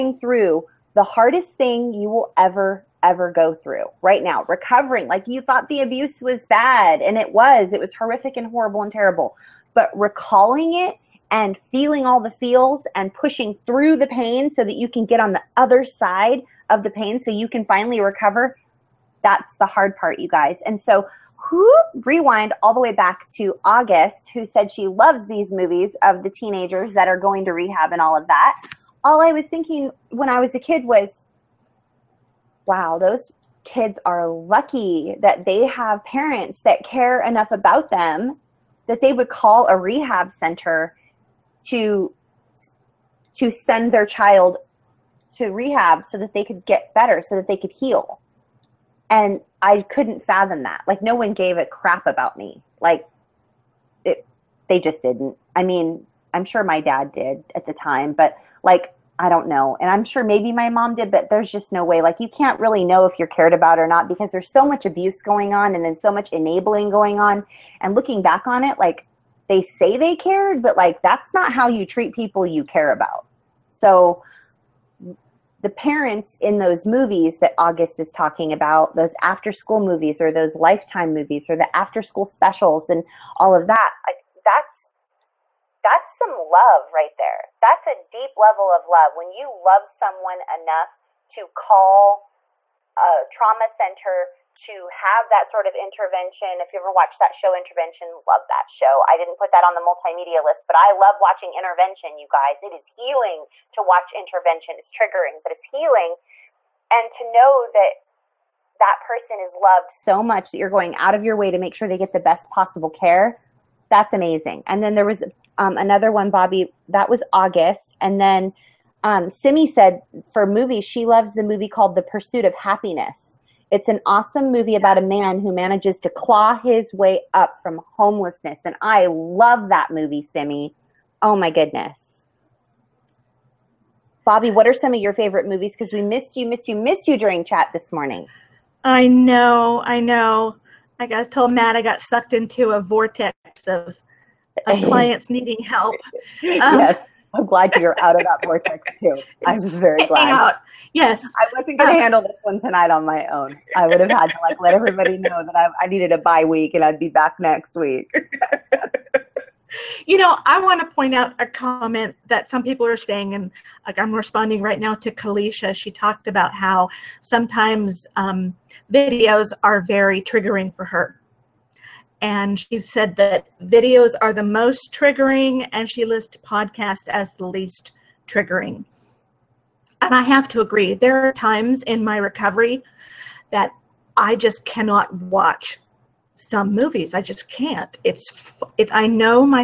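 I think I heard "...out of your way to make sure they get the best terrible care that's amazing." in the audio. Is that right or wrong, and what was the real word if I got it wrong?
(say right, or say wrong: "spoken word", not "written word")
wrong: "possible", not "terrible".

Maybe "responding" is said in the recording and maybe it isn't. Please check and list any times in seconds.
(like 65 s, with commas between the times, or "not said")
164 s.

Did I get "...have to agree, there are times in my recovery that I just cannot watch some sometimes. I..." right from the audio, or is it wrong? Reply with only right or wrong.
wrong.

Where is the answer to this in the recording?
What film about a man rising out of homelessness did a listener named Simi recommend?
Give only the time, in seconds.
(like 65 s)
121 s.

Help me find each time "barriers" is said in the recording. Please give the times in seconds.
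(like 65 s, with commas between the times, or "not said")
not said.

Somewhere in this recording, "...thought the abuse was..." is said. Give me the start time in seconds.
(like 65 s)
5 s.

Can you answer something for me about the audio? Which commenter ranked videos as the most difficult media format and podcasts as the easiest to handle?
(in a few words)
Kalisha.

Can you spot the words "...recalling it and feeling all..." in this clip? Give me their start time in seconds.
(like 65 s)
9 s.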